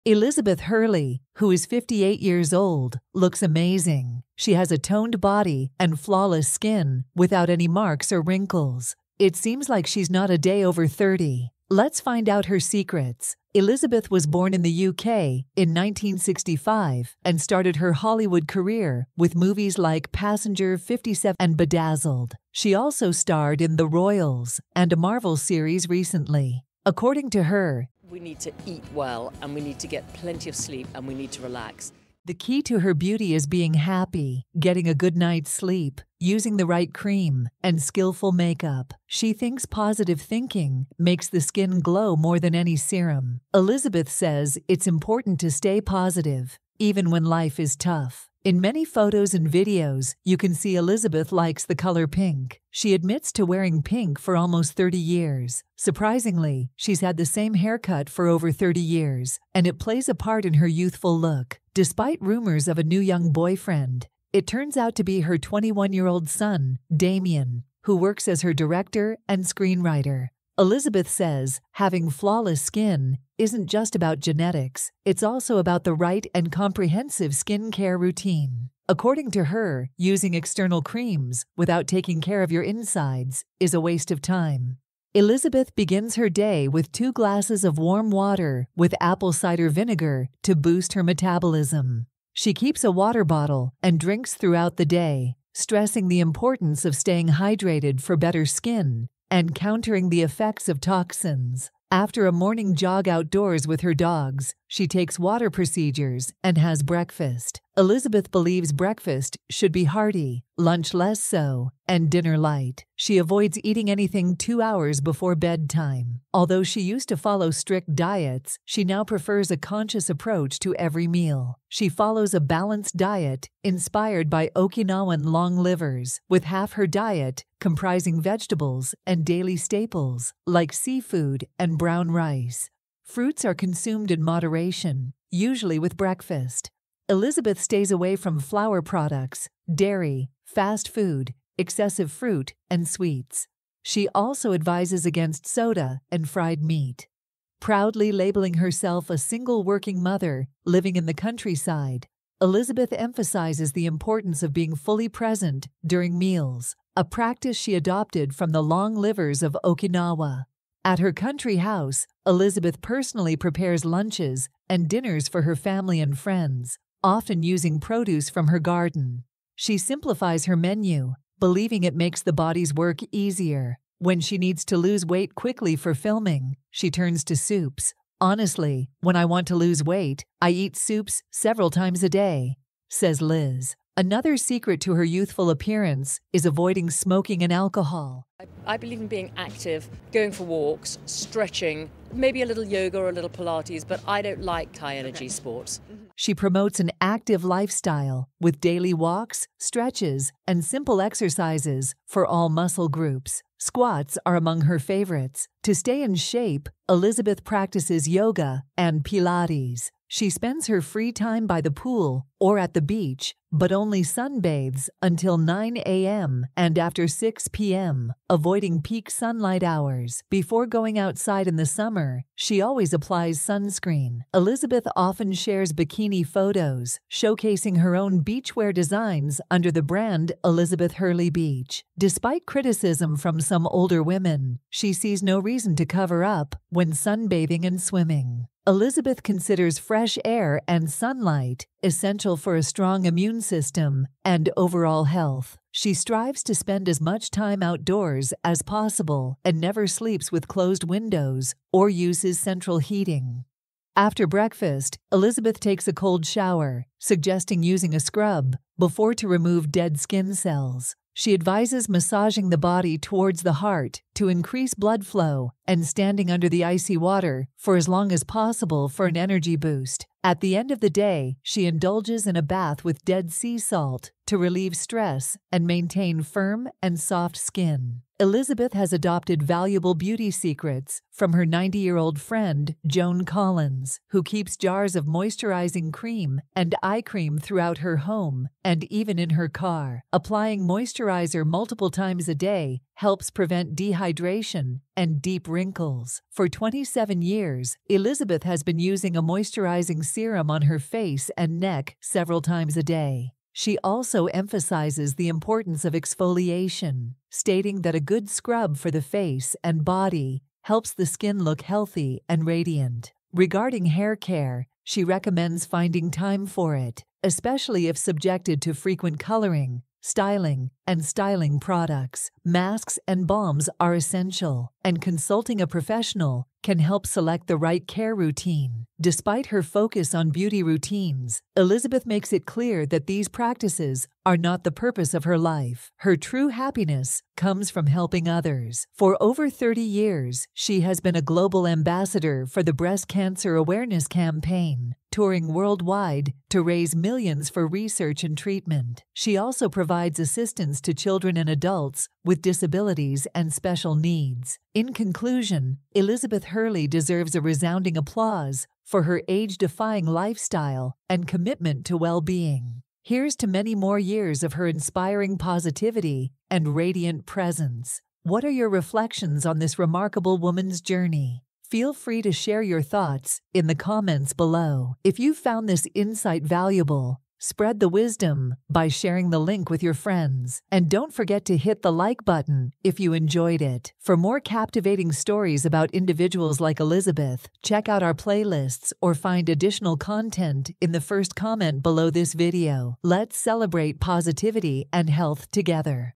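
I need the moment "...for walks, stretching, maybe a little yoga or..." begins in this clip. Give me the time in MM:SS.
03:10.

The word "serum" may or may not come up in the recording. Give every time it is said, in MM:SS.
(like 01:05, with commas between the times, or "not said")
00:42, 05:00.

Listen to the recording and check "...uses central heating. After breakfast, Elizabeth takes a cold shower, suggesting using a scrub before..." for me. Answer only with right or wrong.
right.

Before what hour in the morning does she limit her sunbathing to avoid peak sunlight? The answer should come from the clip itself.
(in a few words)
9 a.m.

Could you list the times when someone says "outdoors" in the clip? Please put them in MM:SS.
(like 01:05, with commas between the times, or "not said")
01:43, 04:07.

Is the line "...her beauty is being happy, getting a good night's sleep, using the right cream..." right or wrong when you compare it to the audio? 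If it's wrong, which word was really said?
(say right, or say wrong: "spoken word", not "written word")
right.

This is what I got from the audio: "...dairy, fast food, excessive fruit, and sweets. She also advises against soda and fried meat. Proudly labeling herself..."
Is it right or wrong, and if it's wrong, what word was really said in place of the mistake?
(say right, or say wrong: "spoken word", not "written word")
right.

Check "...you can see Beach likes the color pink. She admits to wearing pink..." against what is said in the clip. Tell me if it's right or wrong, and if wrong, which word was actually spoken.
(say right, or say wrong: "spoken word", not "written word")
wrong: "Elizabeth", not "Beach".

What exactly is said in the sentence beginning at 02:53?
When she needs to lose weight quickly for filming, she turns to soups.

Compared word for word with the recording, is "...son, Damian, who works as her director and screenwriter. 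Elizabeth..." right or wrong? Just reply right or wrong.
right.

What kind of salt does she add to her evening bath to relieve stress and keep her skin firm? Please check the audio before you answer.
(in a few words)
Dead Sea salt.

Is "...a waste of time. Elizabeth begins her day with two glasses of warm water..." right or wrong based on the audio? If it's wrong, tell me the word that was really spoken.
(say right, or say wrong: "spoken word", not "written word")
right.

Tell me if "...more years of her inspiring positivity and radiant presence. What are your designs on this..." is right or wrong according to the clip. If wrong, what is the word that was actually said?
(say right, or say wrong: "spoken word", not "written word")
wrong: "reflections", not "designs".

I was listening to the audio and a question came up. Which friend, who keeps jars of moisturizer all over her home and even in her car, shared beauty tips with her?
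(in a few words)
Joan Collins.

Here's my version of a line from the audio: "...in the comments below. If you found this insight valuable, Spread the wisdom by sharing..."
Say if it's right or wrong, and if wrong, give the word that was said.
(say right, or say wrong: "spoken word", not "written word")
right.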